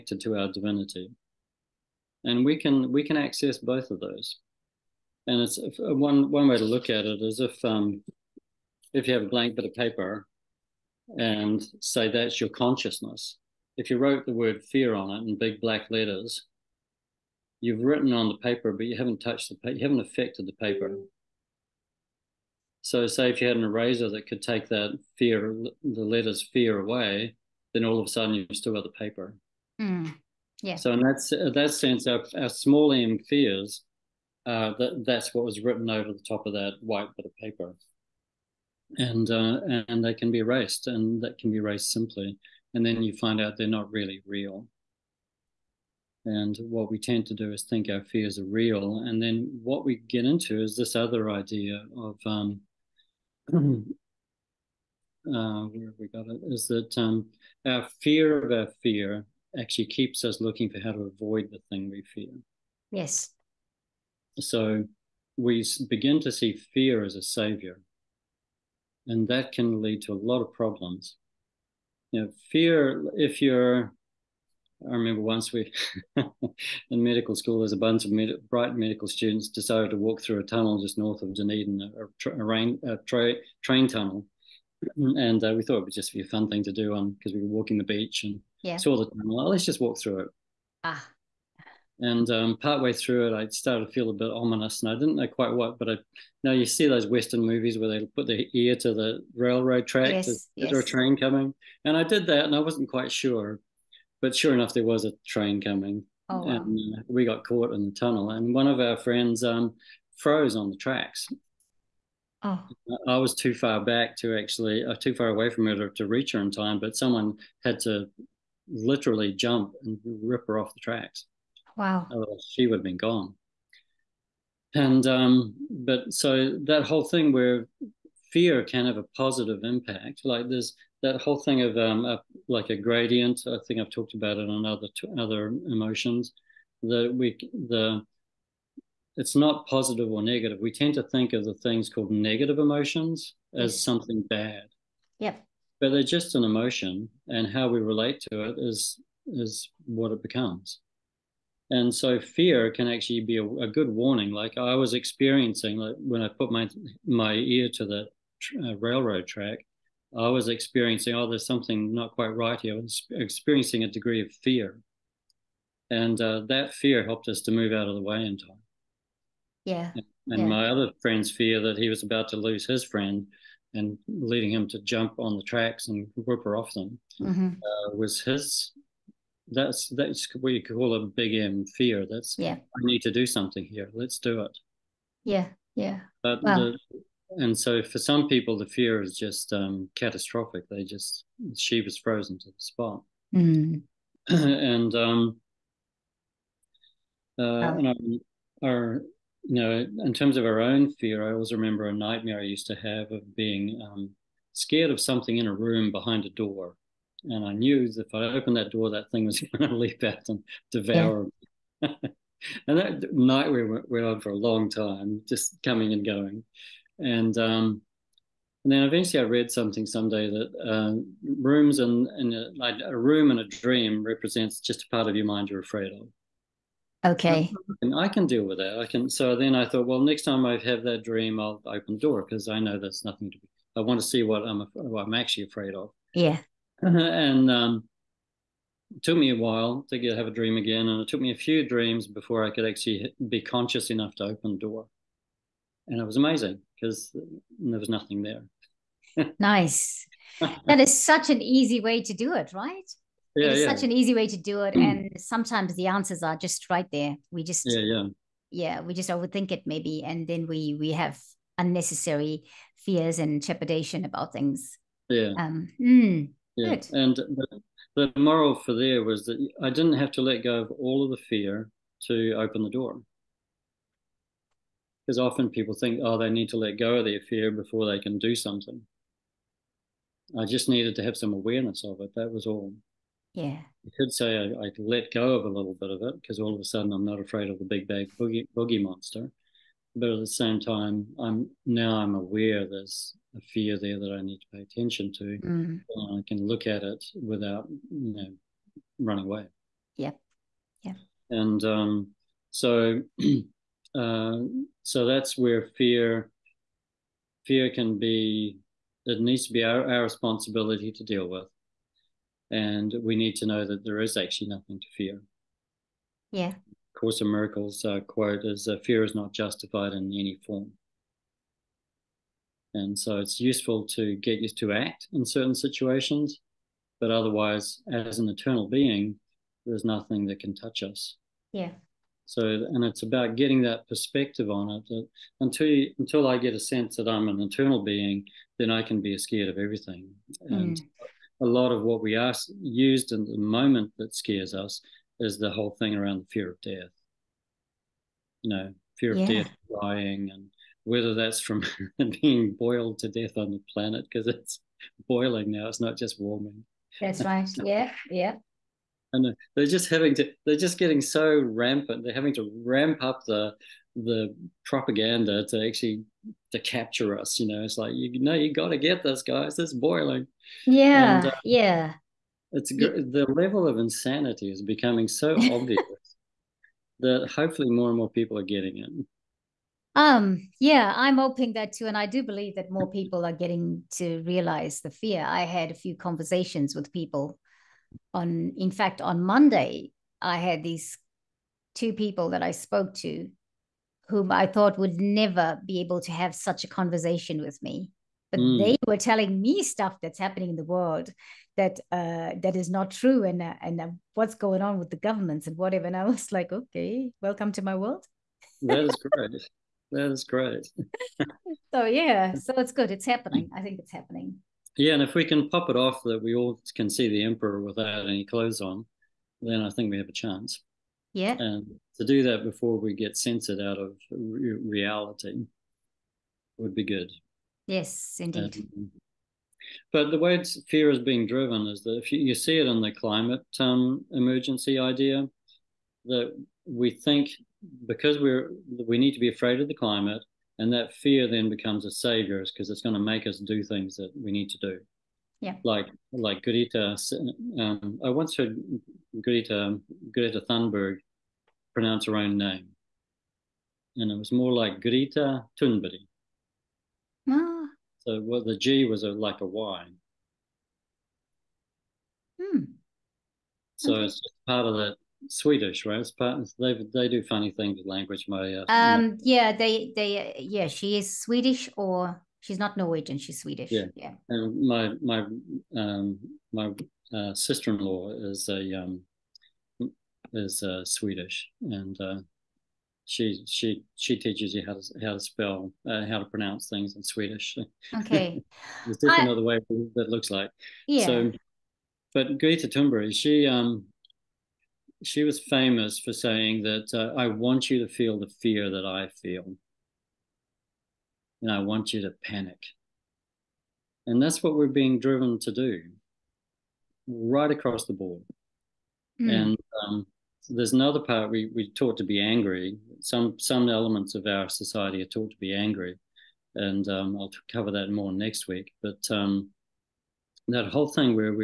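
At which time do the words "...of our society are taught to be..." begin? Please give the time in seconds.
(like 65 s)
514 s.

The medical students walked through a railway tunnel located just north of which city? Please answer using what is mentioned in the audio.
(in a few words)
Dunedin.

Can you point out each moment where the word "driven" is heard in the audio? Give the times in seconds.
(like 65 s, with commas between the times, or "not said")
431 s, 504 s.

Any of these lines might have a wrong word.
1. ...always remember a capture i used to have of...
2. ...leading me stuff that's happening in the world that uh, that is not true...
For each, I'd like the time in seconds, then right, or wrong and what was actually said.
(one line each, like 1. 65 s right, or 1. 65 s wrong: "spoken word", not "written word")
1. 201 s wrong: "nightmare", not "capture"
2. 398 s wrong: "telling", not "leading".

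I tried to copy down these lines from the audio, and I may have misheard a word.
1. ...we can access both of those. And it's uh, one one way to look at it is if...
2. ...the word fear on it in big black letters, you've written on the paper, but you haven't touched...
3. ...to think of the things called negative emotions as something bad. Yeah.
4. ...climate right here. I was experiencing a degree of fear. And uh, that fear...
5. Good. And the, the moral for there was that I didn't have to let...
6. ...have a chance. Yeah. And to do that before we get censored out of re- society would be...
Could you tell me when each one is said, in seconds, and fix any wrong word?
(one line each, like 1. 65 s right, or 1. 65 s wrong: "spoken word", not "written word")
1. 2 s right
2. 14 s right
3. 140 s right
4. 162 s wrong: "quite", not "climate"
5. 266 s right
6. 419 s wrong: "reality", not "society".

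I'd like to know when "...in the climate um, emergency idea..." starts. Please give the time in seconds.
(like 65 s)
432 s.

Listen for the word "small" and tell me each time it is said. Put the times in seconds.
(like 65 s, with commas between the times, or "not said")
32 s.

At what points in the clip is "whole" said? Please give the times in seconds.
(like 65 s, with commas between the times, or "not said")
126 s, 131 s, 345 s, 520 s.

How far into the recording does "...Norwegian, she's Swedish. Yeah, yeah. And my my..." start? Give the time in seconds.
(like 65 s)
472 s.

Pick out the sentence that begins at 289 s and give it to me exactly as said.
But at the same time, I'm now I'm aware there's a fear there that I need to pay attention to.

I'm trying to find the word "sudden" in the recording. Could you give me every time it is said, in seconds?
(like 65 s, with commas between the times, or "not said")
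28 s, 286 s.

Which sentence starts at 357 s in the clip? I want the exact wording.
Yeah, yeah they're just having to.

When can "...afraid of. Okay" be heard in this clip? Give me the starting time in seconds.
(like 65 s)
225 s.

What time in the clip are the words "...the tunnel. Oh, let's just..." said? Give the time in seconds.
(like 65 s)
88 s.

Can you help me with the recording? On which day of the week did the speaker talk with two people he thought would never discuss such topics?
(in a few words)
Monday.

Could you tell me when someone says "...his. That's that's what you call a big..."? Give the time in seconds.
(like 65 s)
178 s.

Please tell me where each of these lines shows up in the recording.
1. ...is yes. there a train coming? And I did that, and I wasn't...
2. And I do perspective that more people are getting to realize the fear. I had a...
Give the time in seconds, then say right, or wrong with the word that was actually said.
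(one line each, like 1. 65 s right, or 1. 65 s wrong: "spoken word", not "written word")
1. 100 s right
2. 381 s wrong: "believe", not "perspective".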